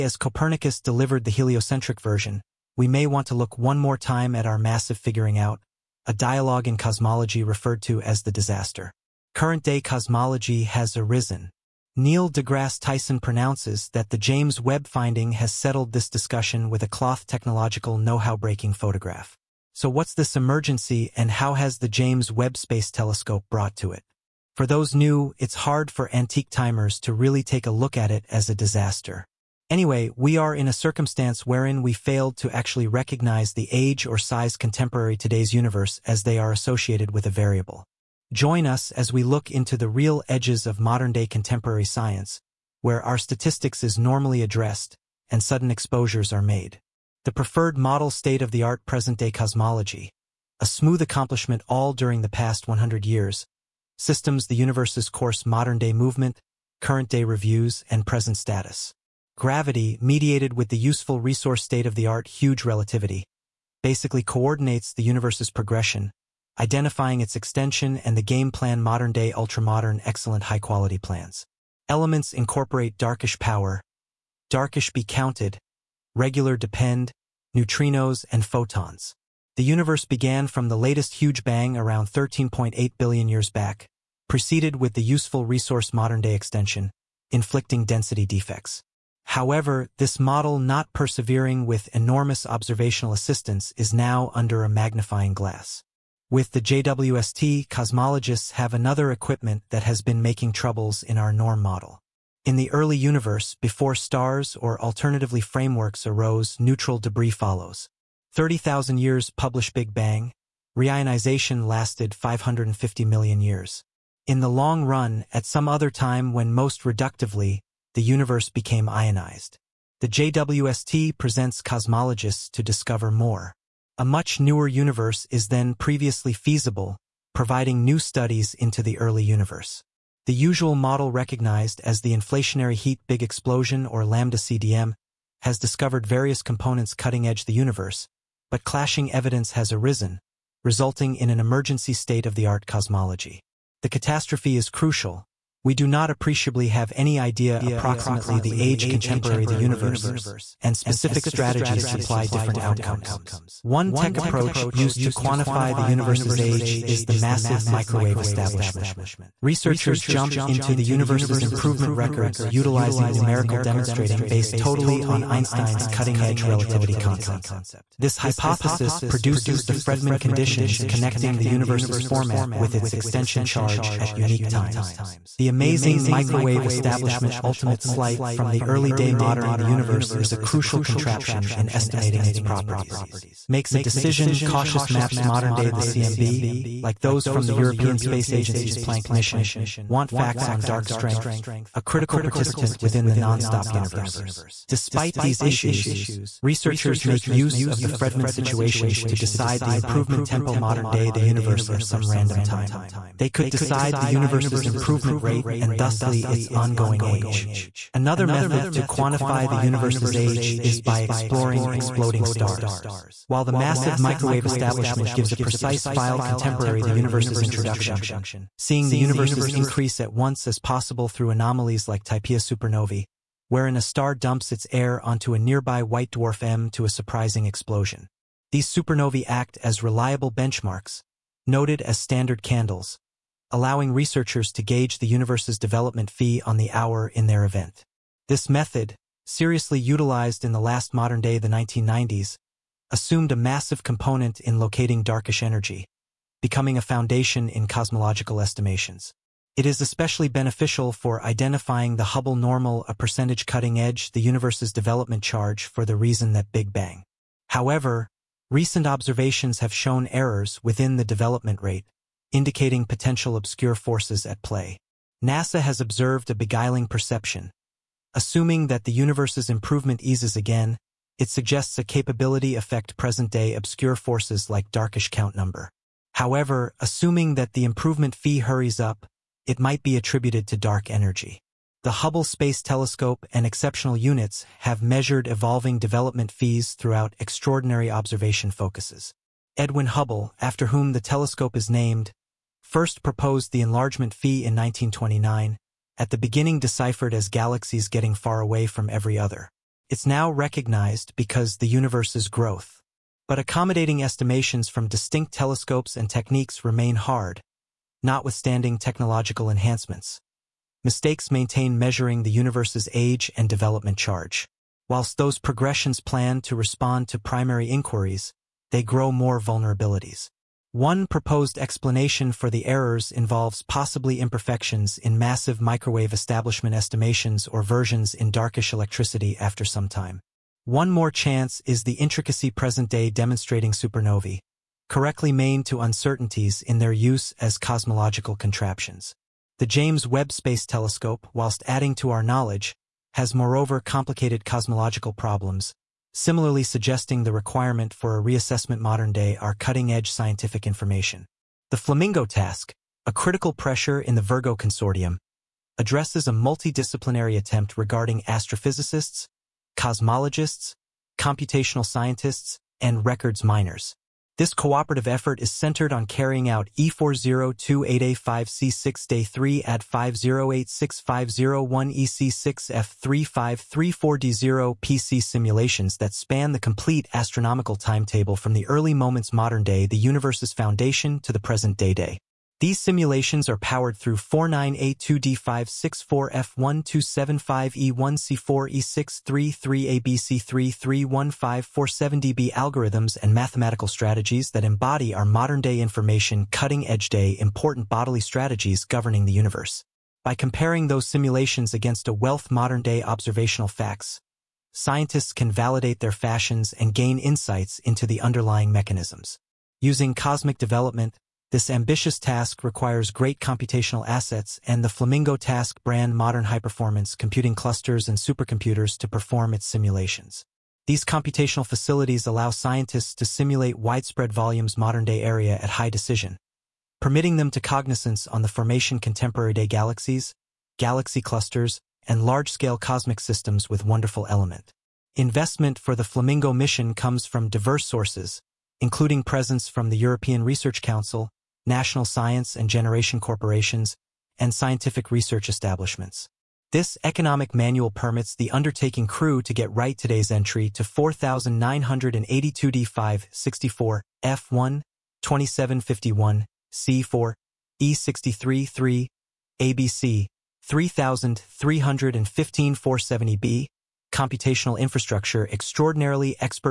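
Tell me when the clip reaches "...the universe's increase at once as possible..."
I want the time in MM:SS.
03:38.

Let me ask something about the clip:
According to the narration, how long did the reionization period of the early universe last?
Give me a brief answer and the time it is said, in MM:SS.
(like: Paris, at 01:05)
550 million years, at 01:52.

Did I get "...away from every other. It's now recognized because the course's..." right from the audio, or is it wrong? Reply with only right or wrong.
wrong.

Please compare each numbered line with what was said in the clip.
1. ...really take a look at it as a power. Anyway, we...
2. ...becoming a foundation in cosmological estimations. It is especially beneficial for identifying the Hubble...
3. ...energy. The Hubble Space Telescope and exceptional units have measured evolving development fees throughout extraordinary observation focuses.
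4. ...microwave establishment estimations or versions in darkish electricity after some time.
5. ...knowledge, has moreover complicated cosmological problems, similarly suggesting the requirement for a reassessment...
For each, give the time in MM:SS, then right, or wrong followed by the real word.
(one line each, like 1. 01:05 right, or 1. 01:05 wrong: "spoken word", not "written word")
1. 00:27 wrong: "disaster", not "power"
2. 04:06 right
3. 04:40 right
4. 05:25 right
5. 05:42 right.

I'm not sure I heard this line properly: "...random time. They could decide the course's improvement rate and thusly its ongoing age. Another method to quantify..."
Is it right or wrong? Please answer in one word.
wrong.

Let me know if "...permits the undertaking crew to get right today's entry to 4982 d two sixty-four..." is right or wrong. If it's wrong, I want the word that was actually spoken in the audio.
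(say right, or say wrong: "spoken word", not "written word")
wrong: "five", not "two".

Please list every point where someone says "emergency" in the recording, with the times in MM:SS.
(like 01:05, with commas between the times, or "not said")
00:20, 02:21.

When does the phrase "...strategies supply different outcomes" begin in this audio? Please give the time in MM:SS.
02:31.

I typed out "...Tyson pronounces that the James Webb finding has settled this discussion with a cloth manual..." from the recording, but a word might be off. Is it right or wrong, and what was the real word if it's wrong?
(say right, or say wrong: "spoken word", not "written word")
wrong: "technological", not "manual".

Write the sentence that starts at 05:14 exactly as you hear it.
Whilst those progressions plan to respond to primary inquiries, they grow more vulnerabilities.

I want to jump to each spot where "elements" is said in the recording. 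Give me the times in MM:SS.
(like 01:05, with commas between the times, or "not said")
01:11, 07:14.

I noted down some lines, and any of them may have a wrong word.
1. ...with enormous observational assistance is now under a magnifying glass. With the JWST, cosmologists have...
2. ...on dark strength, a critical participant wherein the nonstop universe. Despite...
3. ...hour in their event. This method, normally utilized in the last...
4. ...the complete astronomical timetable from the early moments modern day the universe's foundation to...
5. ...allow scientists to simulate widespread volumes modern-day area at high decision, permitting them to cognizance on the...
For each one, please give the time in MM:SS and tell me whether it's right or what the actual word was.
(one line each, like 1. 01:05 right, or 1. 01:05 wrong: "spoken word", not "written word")
1. 01:31 right
2. 03:10 wrong: "within", not "wherein"
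3. 03:56 wrong: "seriously", not "normally"
4. 06:16 right
5. 07:02 right.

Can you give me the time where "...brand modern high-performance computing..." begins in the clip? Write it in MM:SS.
06:55.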